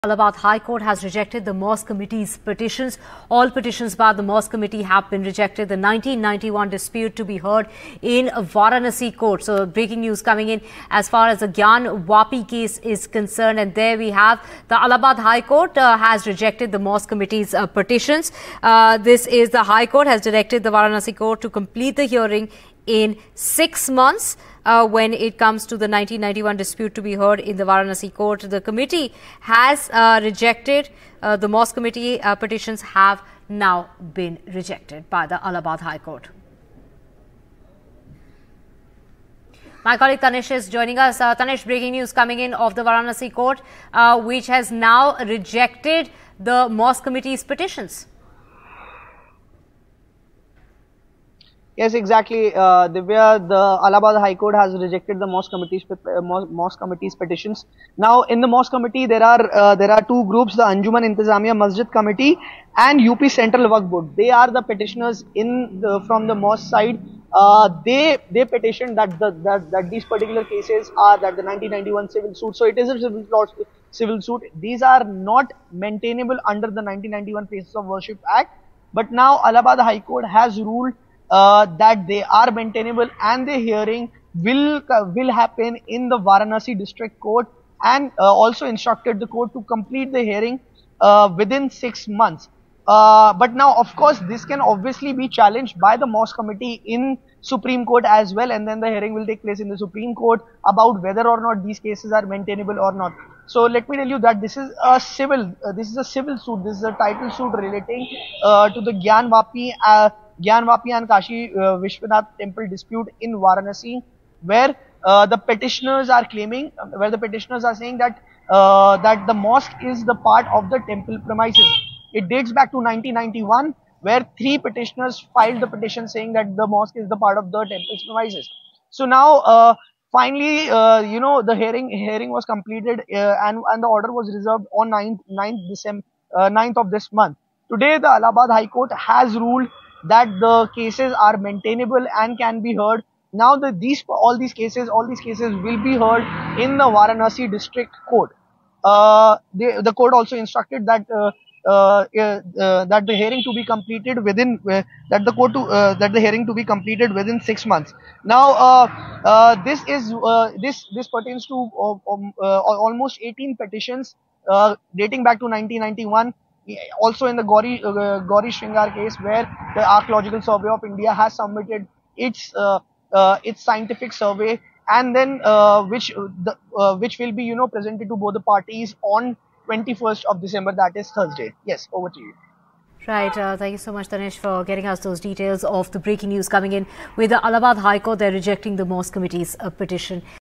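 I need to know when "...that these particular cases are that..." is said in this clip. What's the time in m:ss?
1:09.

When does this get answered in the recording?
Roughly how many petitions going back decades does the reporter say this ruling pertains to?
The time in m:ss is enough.
2:43.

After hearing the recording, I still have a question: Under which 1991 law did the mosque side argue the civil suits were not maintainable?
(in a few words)
Places of Worship Act.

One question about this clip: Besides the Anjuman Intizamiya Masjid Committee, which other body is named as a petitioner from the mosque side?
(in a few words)
UP Central Waqf Board.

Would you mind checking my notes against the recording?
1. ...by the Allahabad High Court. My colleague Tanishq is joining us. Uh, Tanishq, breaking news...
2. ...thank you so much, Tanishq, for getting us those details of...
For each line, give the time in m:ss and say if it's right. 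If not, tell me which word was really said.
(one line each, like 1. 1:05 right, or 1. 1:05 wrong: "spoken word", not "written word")
1. 0:35 right
2. 3:03 right.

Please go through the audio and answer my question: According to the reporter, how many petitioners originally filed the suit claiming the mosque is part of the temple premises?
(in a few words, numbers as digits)
3.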